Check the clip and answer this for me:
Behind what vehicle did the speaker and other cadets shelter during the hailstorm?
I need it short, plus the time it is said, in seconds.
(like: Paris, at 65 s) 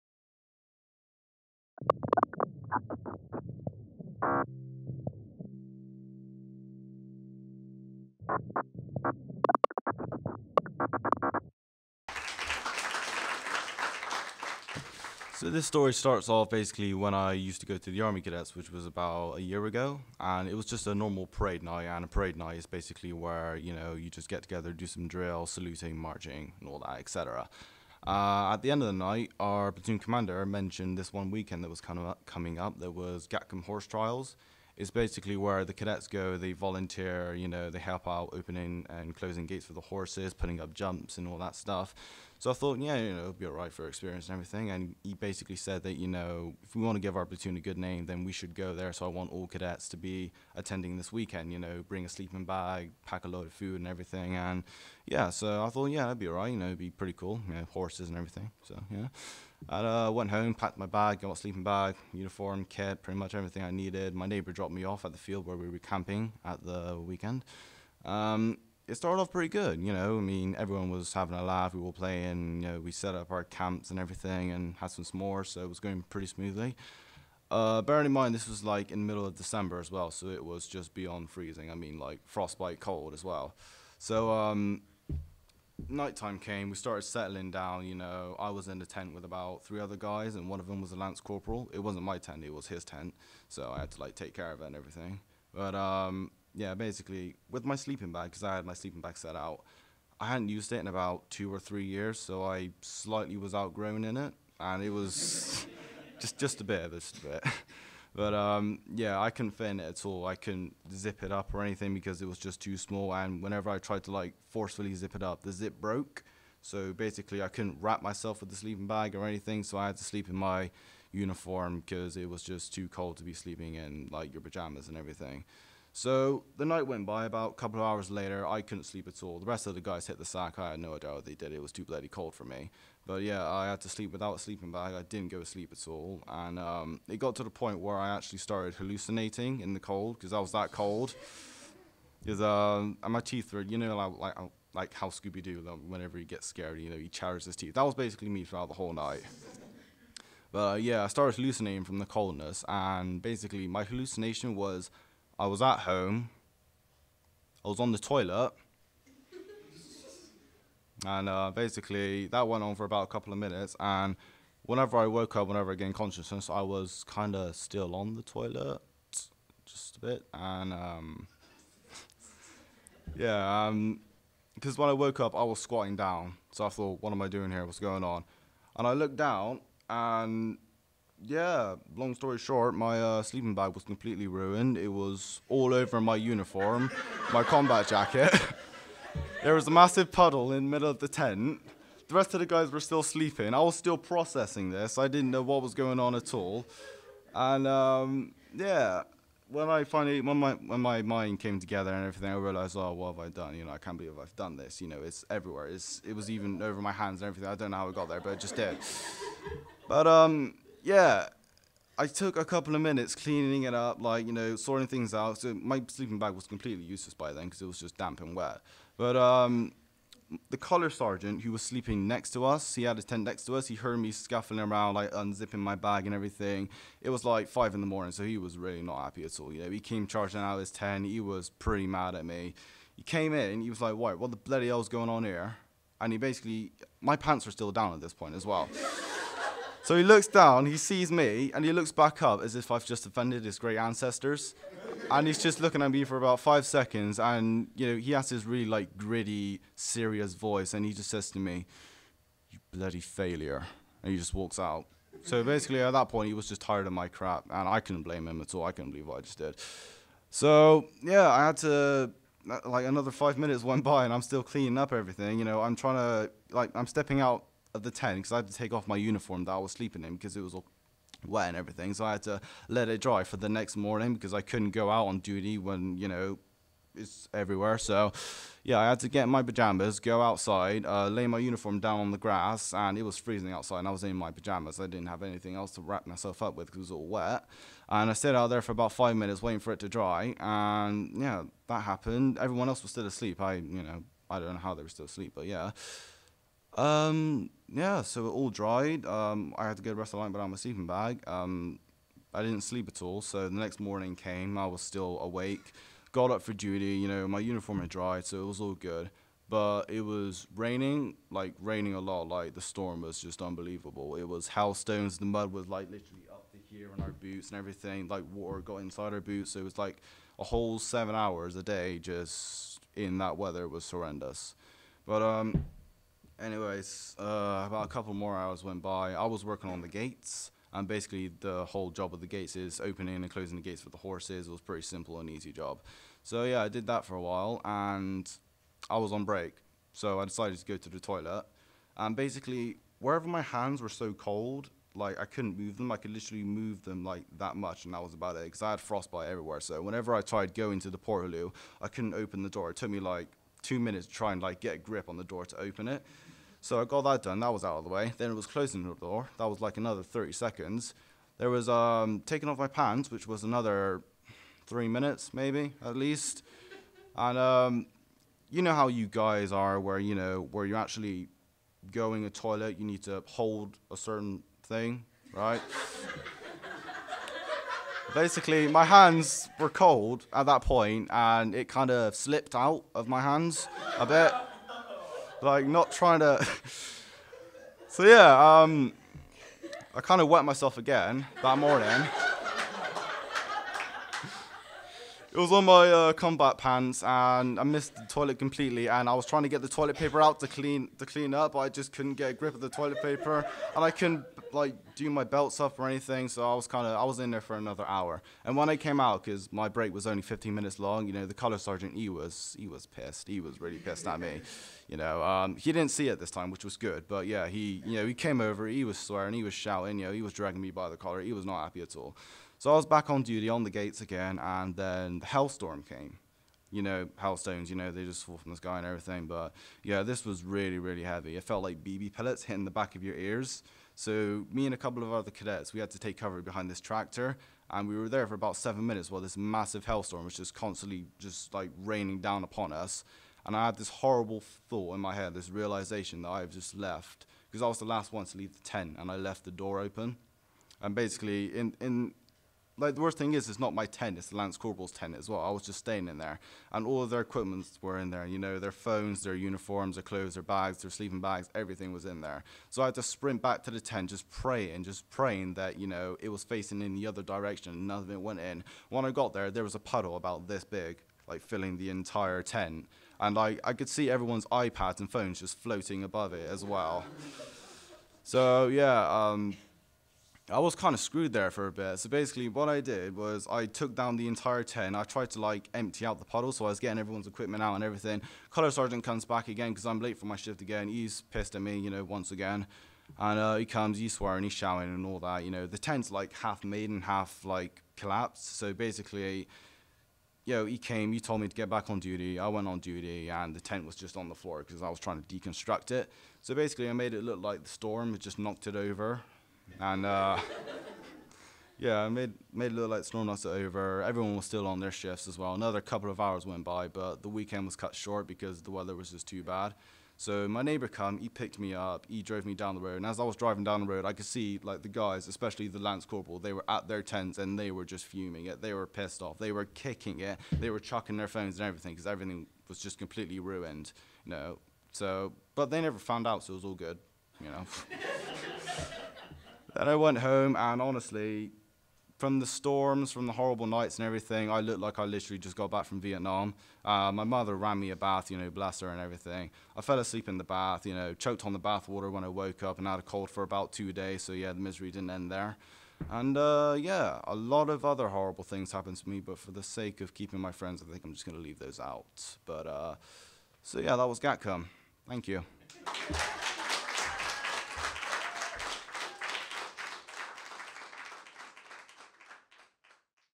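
tractor, at 436 s.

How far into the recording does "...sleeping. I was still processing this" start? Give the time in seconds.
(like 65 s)
193 s.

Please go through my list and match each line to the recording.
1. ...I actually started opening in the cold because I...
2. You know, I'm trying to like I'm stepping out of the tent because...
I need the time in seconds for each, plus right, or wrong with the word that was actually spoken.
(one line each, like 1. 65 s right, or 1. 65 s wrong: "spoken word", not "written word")
1. 137 s wrong: "hallucinating", not "opening"
2. 265 s right.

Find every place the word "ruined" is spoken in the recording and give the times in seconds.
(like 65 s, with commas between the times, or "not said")
184 s, 533 s.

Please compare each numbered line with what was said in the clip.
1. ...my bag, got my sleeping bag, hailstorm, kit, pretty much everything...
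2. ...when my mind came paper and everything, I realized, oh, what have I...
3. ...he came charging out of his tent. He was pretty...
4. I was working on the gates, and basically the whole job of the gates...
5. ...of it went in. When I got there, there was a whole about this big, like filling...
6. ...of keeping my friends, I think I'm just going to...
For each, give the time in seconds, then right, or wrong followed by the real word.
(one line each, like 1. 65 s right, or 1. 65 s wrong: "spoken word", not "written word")
1. 60 s wrong: "uniform", not "hailstorm"
2. 200 s wrong: "together", not "paper"
3. 229 s right
4. 329 s right
5. 467 s wrong: "puddle", not "whole"
6. 560 s right.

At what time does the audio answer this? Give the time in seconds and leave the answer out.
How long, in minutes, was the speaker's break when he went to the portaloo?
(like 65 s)
410 s.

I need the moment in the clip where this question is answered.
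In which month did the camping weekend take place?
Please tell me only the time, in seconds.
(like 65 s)
79 s.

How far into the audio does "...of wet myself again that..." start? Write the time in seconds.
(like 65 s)
390 s.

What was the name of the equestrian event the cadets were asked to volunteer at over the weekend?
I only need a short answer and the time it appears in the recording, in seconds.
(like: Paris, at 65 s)
Gatcombe Horse Trials, at 33 s.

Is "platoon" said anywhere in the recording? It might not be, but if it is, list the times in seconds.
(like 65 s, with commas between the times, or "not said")
29 s, 47 s.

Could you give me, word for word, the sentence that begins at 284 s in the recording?
I didn't have anything else to wrap myself up with because it was all wet.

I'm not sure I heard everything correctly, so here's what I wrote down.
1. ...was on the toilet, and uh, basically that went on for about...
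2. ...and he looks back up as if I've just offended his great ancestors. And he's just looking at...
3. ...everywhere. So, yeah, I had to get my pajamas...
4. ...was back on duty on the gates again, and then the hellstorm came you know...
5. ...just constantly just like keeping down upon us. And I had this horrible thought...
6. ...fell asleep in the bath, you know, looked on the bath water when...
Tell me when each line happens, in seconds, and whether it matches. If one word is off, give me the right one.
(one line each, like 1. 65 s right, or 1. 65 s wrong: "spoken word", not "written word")
1. 157 s right
2. 241 s right
3. 277 s right
4. 422 s right
5. 440 s wrong: "raining", not "keeping"
6. 549 s wrong: "choked", not "looked".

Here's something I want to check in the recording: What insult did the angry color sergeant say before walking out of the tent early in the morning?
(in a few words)
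You bloody failure.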